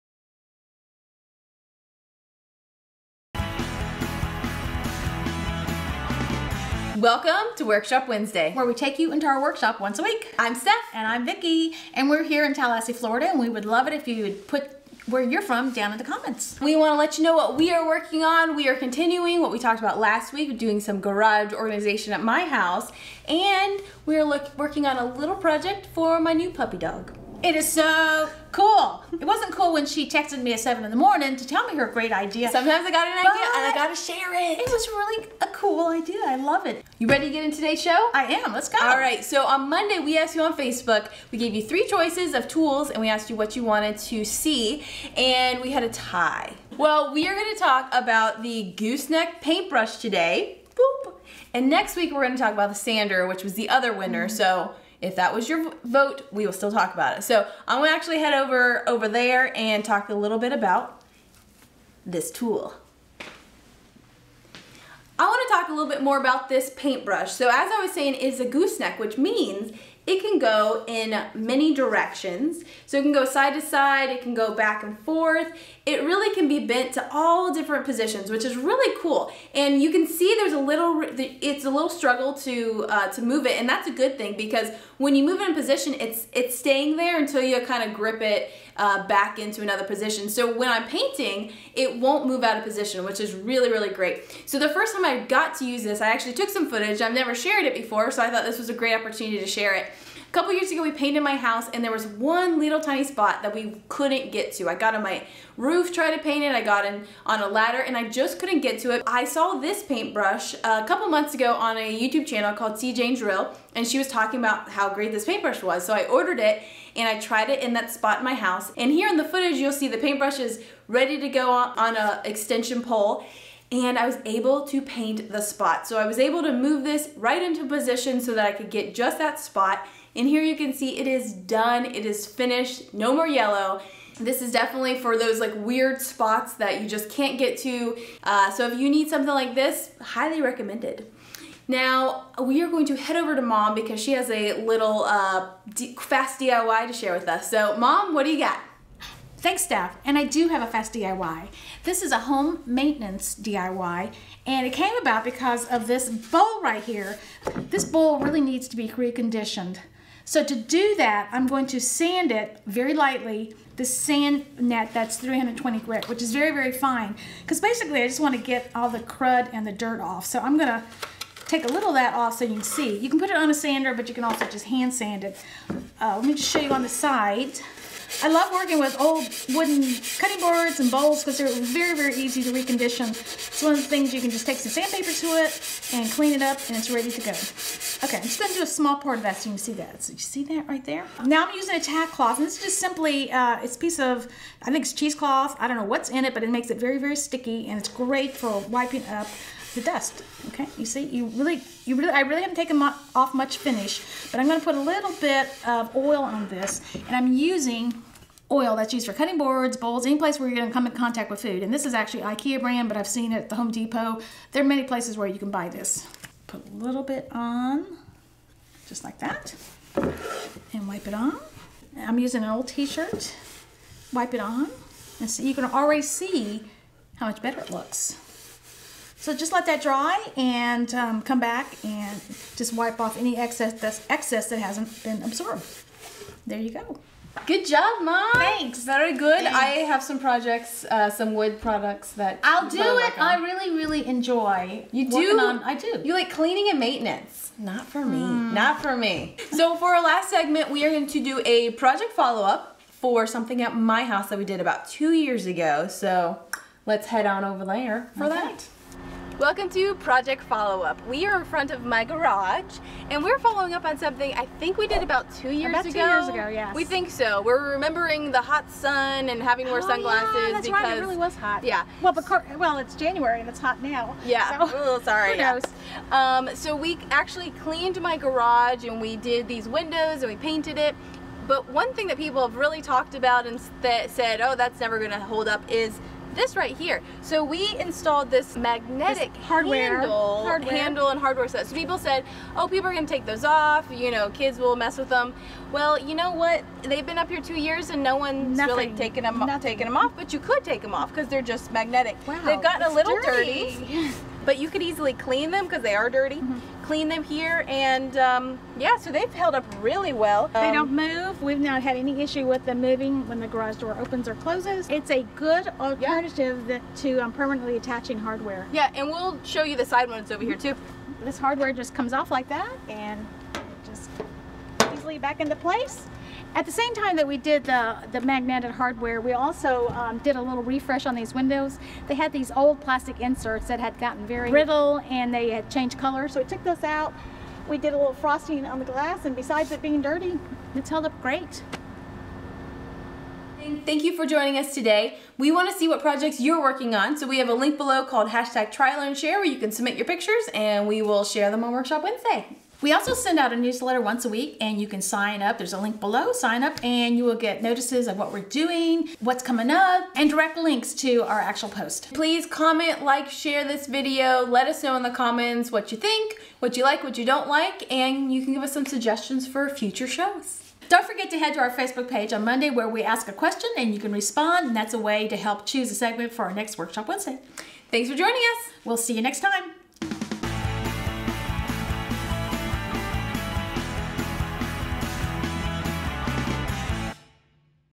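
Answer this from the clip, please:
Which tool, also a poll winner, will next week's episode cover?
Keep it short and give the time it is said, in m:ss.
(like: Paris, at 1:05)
The sander, at 0:52.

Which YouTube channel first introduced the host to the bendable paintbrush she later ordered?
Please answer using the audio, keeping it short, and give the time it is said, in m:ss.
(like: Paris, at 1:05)
See Jane Drill, at 1:52.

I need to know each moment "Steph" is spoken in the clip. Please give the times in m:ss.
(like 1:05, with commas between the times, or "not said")
0:10, 2:29.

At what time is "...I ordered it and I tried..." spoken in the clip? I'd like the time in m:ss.
1:55.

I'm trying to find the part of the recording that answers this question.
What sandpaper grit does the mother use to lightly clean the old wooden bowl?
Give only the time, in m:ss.
2:45.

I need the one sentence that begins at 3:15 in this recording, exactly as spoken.
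I don't know what's in it, but it makes it very, very sticky and it's great for wiping up the dust.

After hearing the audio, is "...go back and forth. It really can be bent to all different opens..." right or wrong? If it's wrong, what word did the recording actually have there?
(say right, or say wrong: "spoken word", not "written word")
wrong: "positions", not "opens".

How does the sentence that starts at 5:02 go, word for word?
Wow, They've gotten a little dirty.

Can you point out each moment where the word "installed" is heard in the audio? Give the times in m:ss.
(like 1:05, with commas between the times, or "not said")
4:47.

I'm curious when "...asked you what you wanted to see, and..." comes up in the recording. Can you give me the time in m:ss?
0:43.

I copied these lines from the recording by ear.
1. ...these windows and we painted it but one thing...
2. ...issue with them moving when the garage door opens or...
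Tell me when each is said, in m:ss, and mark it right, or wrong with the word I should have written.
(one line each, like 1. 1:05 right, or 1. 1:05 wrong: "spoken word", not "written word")
1. 4:39 right
2. 5:12 right.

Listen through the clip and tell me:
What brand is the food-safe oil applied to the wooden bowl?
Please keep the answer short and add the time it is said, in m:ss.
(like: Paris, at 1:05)
IKEA, at 3:32.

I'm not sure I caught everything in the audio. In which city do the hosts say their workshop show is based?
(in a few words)
Tallahassee, Florida.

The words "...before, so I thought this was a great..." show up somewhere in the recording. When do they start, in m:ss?
1:37.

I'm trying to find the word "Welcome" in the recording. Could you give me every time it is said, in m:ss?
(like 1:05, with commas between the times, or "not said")
0:07, 4:19.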